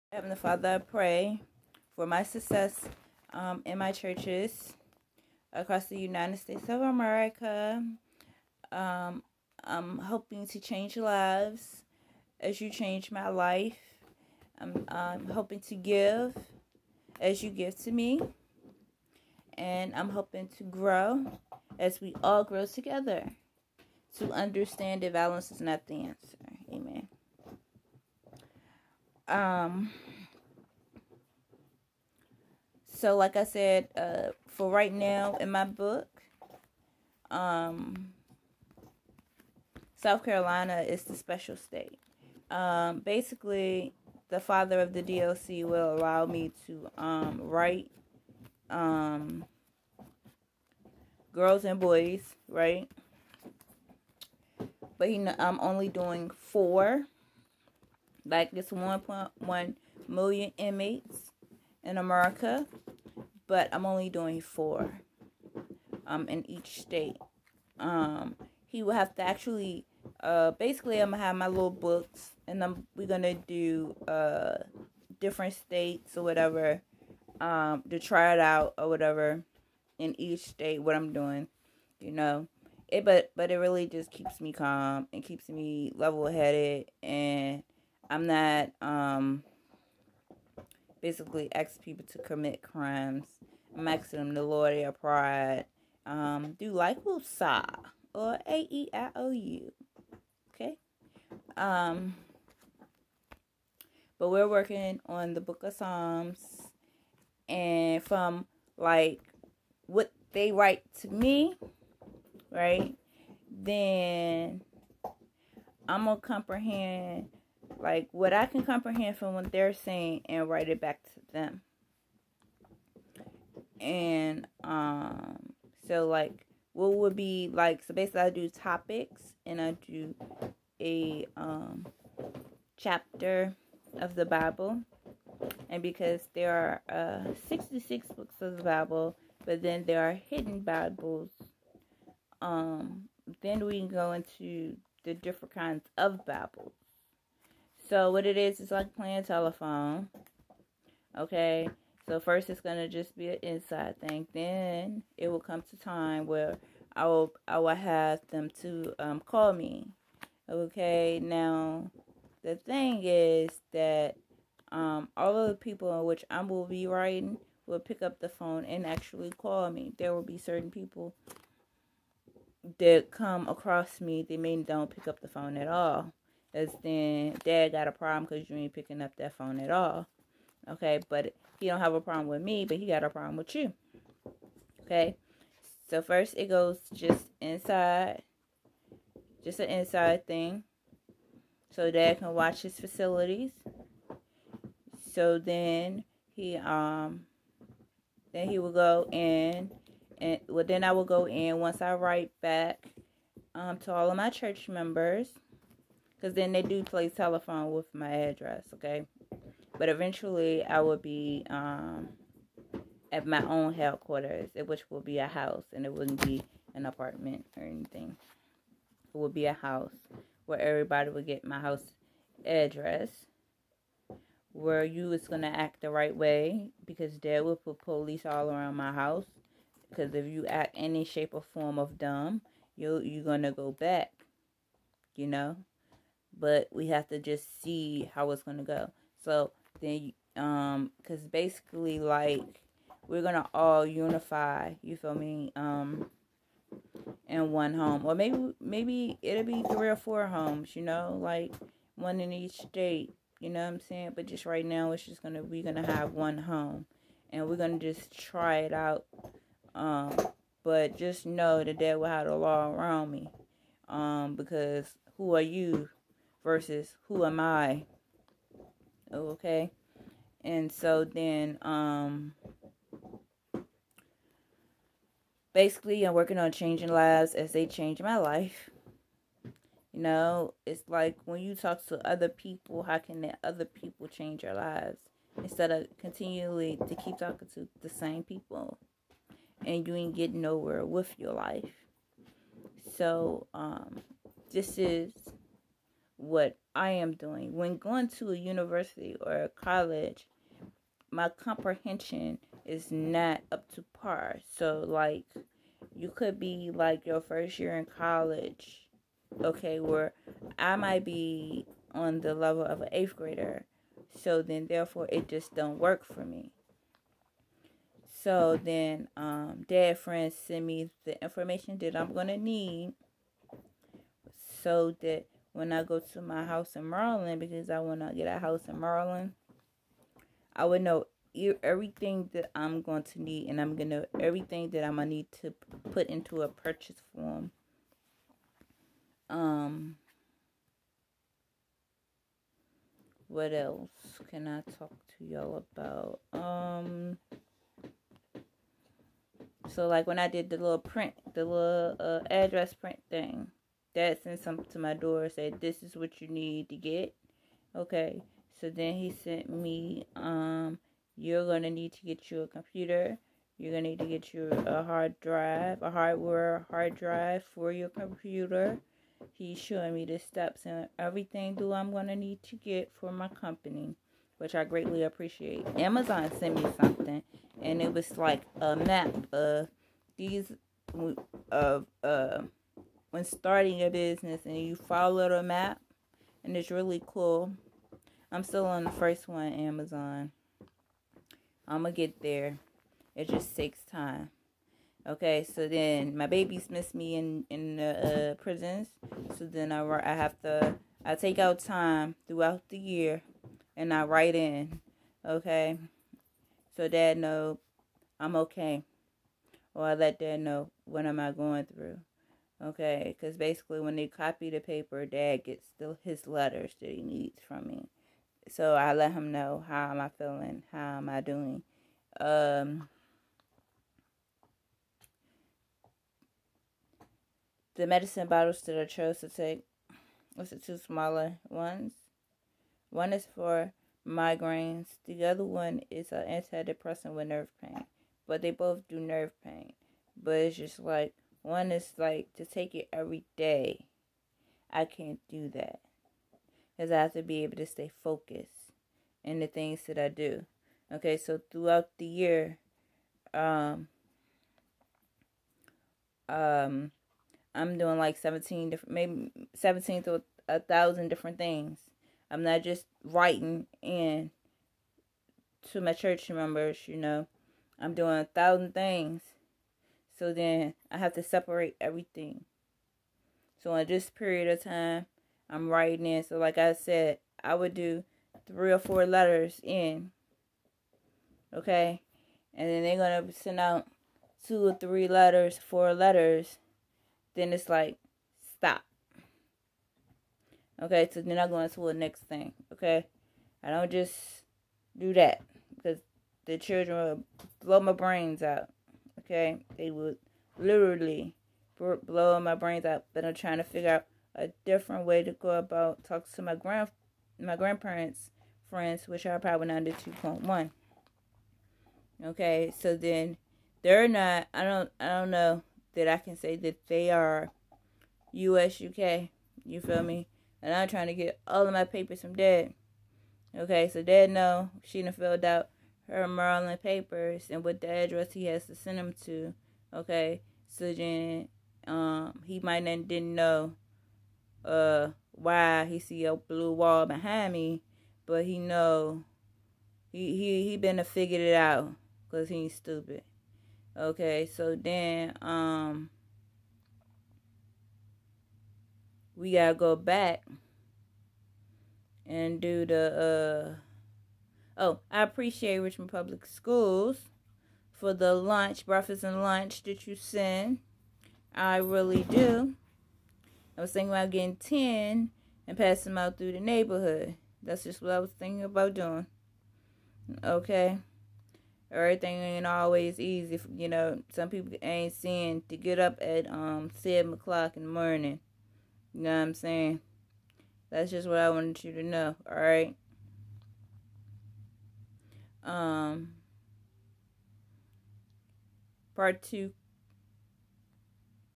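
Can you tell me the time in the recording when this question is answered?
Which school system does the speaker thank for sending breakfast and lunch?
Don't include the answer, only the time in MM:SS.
09:15.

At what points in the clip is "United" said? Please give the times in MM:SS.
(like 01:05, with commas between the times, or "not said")
00:05.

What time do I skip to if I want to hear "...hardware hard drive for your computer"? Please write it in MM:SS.
06:05.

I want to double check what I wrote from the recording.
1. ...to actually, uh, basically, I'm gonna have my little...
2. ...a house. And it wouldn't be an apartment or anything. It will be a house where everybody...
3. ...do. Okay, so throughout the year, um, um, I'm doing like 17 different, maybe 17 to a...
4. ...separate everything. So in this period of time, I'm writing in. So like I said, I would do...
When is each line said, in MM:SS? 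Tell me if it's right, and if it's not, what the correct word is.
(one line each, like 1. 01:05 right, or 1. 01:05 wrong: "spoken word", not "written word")
1. 01:09 right
2. 03:35 right
3. 07:30 right
4. 07:51 right.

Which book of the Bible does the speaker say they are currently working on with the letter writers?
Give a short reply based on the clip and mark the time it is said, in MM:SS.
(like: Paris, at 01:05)
Psalms, at 01:45.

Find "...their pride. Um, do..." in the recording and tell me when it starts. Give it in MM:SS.
01:34.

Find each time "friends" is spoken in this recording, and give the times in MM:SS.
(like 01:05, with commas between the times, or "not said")
05:19, 08:28.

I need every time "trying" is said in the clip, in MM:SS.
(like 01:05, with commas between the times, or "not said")
08:23, 08:40.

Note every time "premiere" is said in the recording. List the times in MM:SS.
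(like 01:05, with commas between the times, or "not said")
not said.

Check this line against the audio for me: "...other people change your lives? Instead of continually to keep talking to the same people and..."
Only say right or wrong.
right.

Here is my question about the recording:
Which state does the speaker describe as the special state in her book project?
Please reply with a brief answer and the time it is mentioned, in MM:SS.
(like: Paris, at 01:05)
South Carolina, at 00:39.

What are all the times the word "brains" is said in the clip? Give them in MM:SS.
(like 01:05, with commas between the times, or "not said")
08:17, 08:22.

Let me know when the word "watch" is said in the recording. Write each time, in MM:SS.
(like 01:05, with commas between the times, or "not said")
03:12.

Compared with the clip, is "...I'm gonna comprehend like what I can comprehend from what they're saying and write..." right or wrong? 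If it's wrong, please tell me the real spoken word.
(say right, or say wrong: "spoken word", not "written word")
right.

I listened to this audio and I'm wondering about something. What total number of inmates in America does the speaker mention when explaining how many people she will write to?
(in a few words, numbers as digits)
1.1 million.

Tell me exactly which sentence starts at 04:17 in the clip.
And we're going to just try it out.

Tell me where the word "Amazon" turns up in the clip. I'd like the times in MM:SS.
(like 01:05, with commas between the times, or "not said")
06:15, 06:29.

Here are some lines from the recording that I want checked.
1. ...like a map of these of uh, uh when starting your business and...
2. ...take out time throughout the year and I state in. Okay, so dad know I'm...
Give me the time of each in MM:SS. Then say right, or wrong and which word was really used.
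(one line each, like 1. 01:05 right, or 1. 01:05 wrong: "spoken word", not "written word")
1. 06:18 right
2. 06:41 wrong: "write", not "state".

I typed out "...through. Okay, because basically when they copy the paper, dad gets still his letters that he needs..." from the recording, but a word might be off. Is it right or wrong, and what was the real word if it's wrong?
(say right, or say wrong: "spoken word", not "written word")
right.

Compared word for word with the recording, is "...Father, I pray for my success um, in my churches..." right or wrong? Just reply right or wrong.
right.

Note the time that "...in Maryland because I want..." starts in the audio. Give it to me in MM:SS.
05:26.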